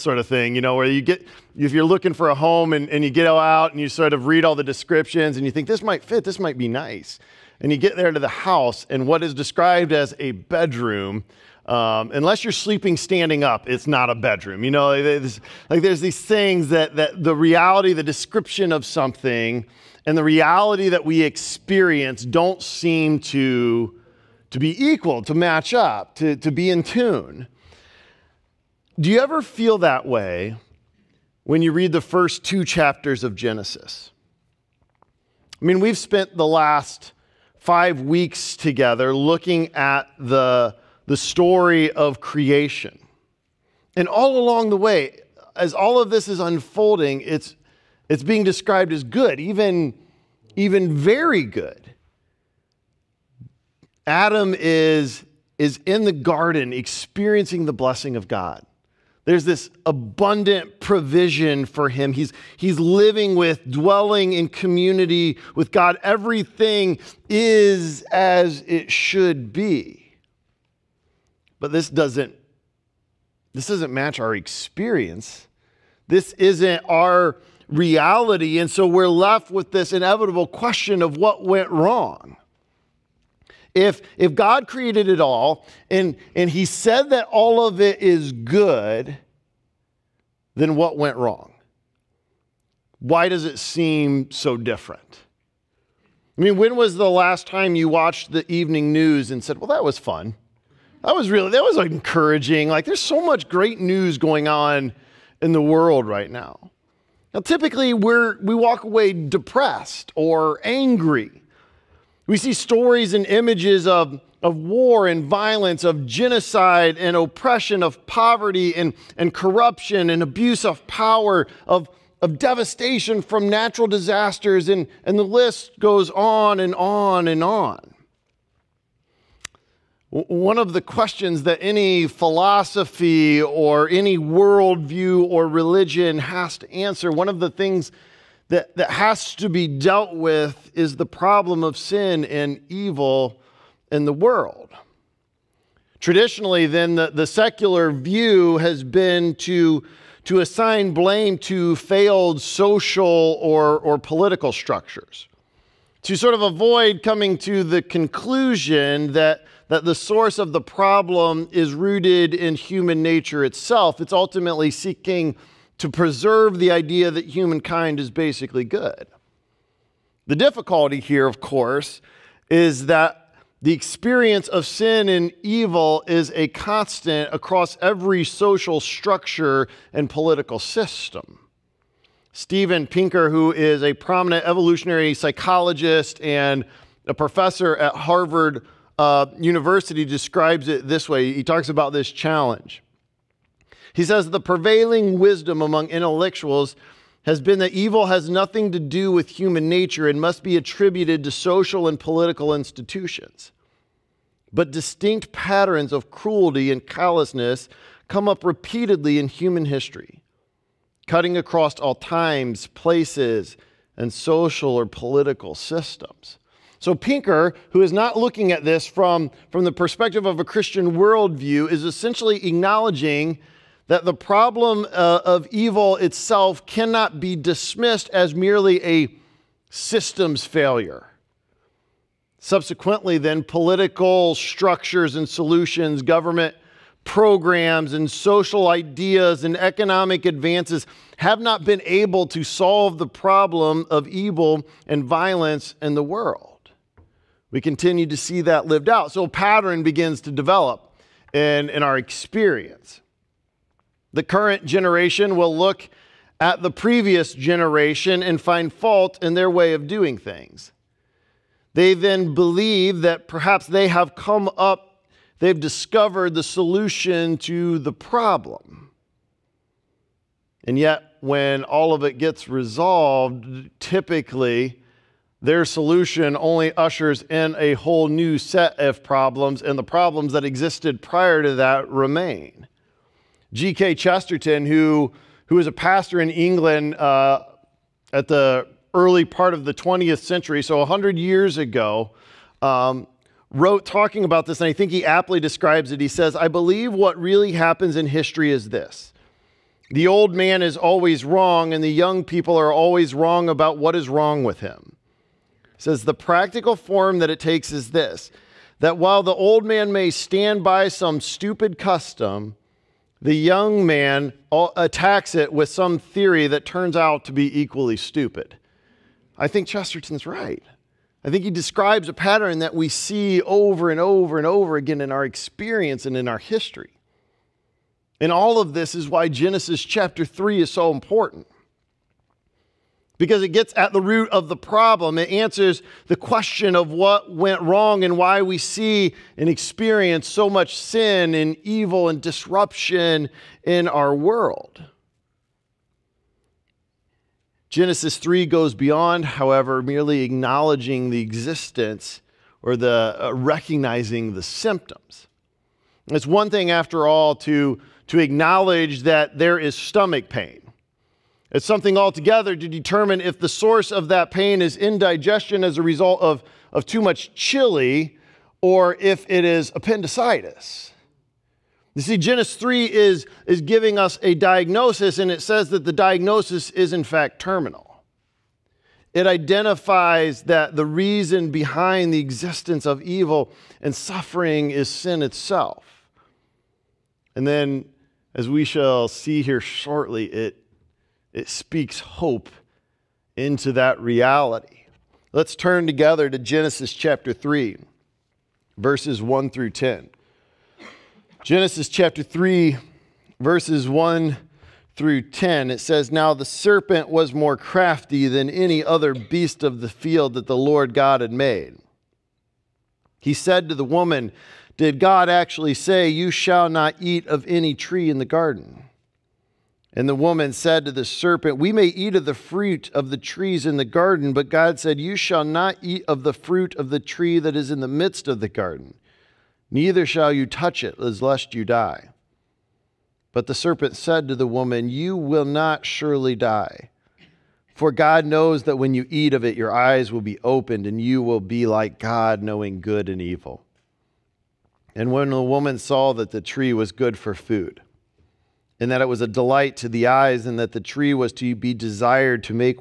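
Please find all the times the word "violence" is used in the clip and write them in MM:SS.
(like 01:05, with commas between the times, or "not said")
01:55, 04:05.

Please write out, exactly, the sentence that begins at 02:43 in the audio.
It's ultimately seeking to preserve the idea that humankind is basically good.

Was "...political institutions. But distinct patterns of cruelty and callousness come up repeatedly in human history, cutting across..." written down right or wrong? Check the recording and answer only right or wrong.
right.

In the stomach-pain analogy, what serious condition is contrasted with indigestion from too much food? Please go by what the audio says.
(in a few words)
Appendicitis.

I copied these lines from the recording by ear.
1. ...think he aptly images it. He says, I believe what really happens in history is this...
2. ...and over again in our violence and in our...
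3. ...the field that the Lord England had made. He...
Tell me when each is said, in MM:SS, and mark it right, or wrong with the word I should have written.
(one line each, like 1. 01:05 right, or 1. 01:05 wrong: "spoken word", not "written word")
1. 04:54 wrong: "describes", not "images"
2. 05:24 wrong: "experience", not "violence"
3. 06:49 wrong: "God", not "England".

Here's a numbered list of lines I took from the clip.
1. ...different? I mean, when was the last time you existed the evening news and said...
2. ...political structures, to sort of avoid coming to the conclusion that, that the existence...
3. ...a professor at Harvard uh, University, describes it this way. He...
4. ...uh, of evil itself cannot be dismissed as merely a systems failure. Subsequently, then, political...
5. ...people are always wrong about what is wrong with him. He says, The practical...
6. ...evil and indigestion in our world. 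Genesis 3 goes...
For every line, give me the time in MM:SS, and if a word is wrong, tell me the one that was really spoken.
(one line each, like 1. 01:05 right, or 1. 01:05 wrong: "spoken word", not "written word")
1. 01:34 wrong: "watched", not "existed"
2. 02:33 wrong: "source", not "existence"
3. 03:07 right
4. 03:44 right
5. 05:02 right
6. 05:41 wrong: "disruption", not "indigestion".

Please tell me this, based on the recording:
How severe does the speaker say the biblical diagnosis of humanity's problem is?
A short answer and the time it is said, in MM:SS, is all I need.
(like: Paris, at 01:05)
Terminal, at 06:17.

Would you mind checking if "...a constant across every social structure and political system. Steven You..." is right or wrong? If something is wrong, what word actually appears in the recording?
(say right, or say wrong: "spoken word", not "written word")
wrong: "Pinker", not "You".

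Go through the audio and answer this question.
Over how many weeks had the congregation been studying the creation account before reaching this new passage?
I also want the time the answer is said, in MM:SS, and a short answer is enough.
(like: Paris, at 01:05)
5, at 00:37.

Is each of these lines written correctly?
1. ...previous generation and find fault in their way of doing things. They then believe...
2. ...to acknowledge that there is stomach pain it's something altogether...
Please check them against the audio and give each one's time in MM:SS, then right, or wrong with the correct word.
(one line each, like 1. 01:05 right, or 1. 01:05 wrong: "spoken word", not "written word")
1. 04:16 right
2. 05:58 right.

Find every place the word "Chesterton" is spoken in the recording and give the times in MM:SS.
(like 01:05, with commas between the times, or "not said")
04:43, 05:19.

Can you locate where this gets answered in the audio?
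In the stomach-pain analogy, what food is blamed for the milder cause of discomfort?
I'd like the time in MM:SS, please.
06:07.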